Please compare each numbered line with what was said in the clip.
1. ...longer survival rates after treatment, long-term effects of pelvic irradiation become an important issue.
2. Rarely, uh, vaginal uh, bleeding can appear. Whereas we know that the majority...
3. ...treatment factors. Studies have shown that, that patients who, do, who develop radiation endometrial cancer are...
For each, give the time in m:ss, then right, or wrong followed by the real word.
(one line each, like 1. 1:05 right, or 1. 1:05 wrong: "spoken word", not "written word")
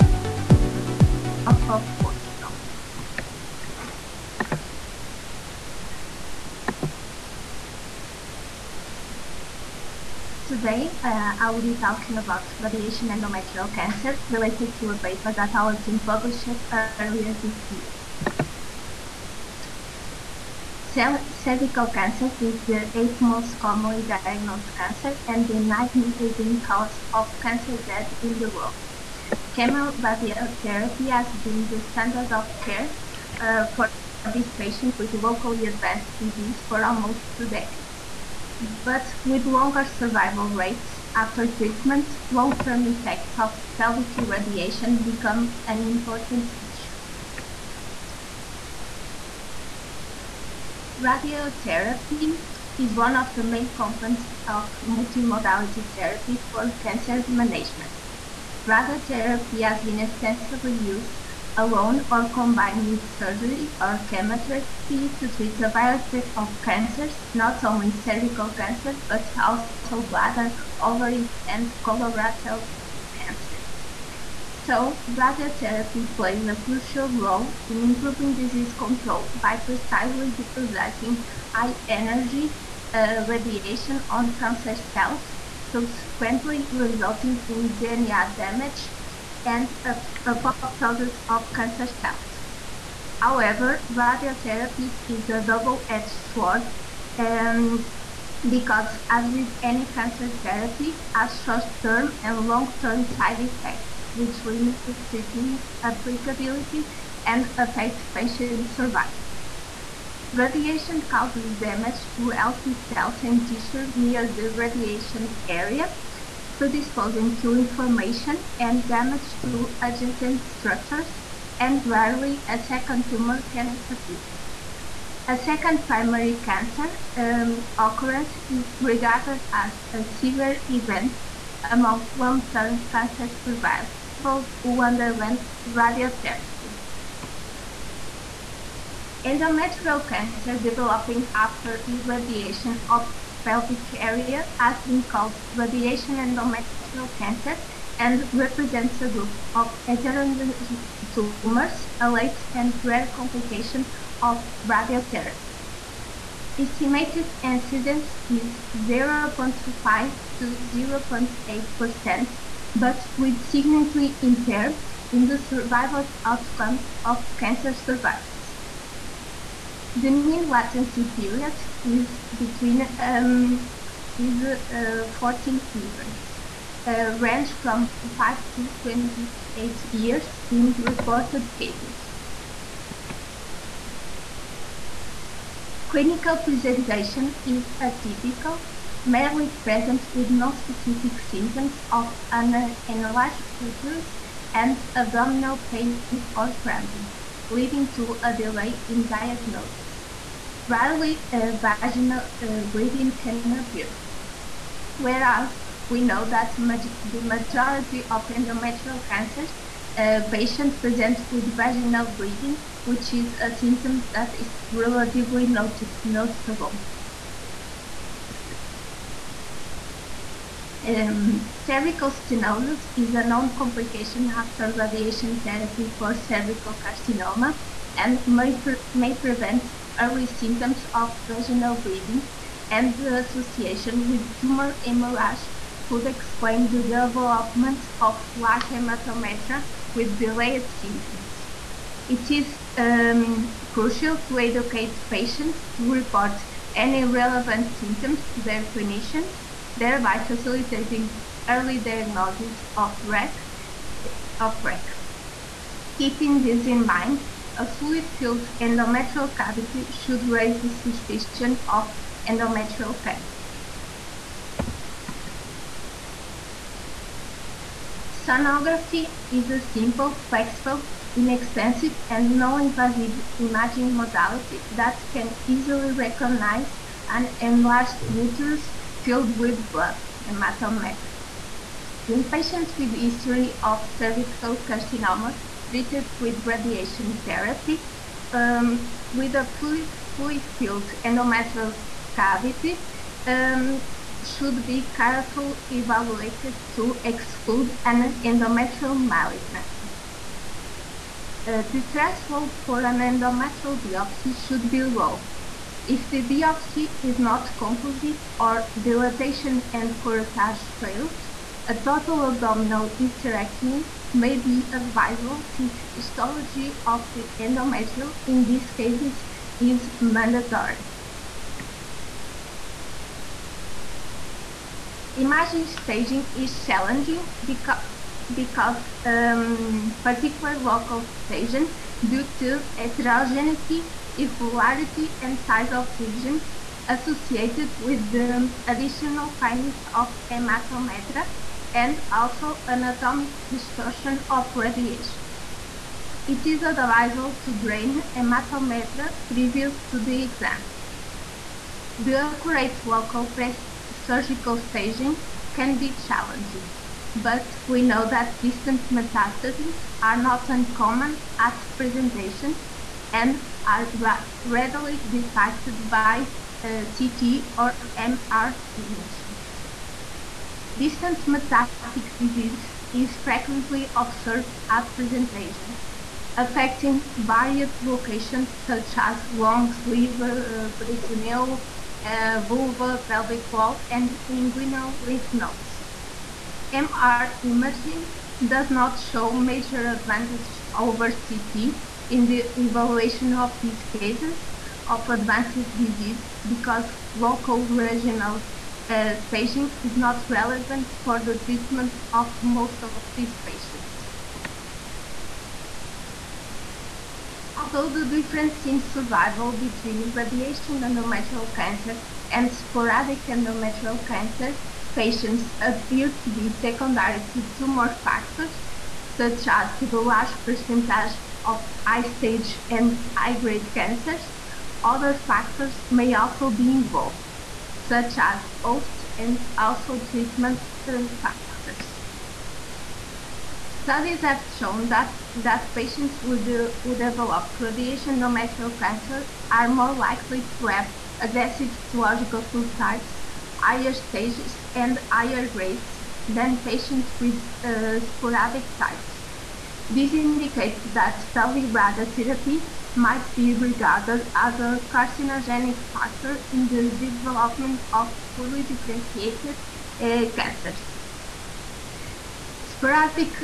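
1. 0:39 right
2. 3:20 right
3. 7:10 right.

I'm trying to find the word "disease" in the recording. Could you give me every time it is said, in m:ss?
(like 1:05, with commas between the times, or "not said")
0:36, 1:18, 6:12, 6:35.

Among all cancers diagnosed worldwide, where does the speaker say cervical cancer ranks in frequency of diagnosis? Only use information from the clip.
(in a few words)
eighth.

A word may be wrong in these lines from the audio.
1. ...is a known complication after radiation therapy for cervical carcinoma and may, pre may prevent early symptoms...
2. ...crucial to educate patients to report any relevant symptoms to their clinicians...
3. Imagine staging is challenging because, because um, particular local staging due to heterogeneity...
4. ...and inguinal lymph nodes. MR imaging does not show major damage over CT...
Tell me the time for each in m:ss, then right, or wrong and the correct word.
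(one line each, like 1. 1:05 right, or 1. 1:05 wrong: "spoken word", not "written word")
1. 3:42 right
2. 4:03 right
3. 5:25 right
4. 6:23 wrong: "advantage", not "damage".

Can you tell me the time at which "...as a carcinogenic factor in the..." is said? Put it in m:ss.
7:34.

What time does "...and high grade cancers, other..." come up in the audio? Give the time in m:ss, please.
7:02.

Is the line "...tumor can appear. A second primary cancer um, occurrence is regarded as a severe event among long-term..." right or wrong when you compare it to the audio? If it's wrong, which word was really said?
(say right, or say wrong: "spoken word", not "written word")
right.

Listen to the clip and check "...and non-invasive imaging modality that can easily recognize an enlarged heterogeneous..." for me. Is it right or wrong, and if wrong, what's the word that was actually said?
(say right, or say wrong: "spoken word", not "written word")
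wrong: "uterus", not "heterogeneous".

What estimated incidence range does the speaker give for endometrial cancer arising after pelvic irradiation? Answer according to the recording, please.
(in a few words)
0.5 to 0.8%.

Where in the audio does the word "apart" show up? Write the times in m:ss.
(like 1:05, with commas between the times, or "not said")
not said.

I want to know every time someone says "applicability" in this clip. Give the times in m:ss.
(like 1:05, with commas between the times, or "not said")
1:45.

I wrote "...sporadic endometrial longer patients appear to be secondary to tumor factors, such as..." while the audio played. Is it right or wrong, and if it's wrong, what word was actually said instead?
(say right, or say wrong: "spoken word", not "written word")
wrong: "cancer", not "longer".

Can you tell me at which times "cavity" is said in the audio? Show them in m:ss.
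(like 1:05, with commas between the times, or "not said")
4:19, 4:52.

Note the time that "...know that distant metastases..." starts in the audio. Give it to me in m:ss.
5:57.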